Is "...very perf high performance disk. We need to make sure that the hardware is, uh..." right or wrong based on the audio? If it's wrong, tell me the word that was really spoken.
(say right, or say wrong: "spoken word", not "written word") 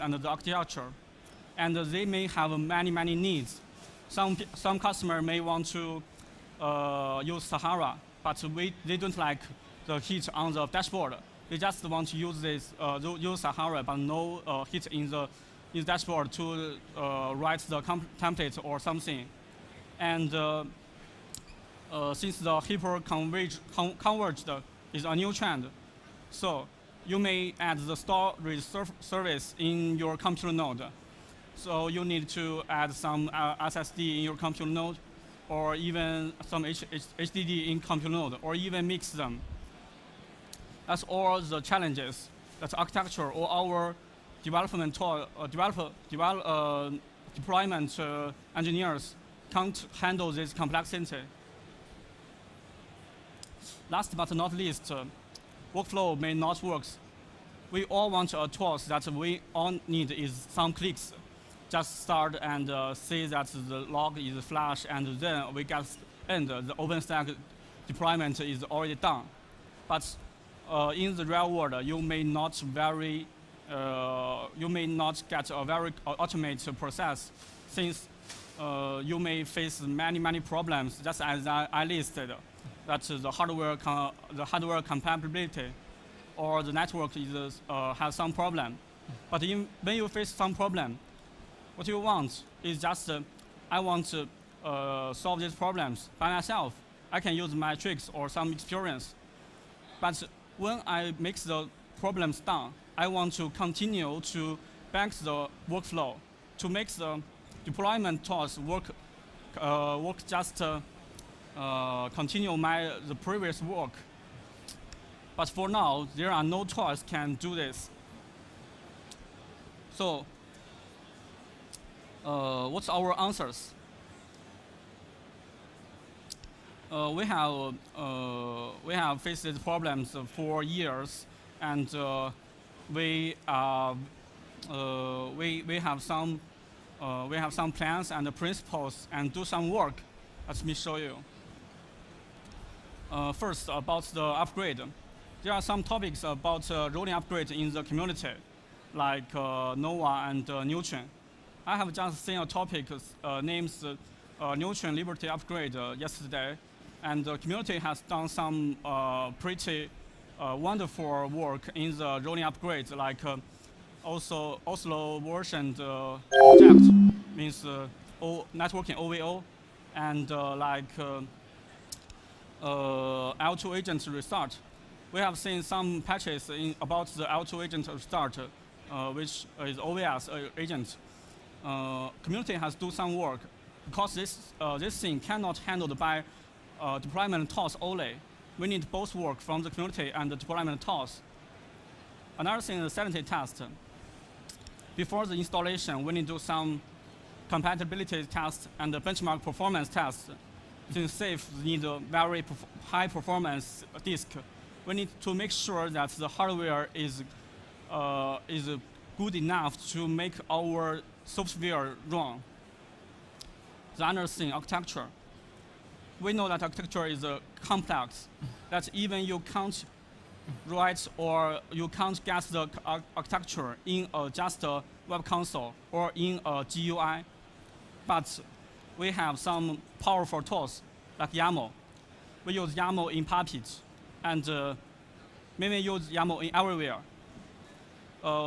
right.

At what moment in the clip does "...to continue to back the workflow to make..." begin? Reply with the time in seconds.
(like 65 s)
103 s.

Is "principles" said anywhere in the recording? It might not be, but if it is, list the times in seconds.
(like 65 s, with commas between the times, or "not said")
138 s.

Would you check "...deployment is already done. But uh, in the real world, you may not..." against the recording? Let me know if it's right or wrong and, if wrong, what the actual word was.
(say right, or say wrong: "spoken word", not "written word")
right.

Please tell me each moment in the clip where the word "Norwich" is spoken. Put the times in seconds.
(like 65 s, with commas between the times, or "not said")
not said.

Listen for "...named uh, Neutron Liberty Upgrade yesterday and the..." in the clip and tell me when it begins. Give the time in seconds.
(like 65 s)
153 s.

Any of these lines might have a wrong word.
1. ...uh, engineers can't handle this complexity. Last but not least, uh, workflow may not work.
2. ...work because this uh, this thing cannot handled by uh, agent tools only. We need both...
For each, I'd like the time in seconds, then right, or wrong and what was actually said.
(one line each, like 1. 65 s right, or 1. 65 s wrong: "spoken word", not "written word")
1. 47 s right
2. 183 s wrong: "deployment", not "agent".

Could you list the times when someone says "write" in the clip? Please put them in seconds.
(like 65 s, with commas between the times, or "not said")
17 s, 220 s.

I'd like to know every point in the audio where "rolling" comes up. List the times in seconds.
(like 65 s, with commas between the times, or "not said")
146 s, 162 s.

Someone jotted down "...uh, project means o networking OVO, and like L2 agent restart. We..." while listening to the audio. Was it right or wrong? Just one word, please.
right.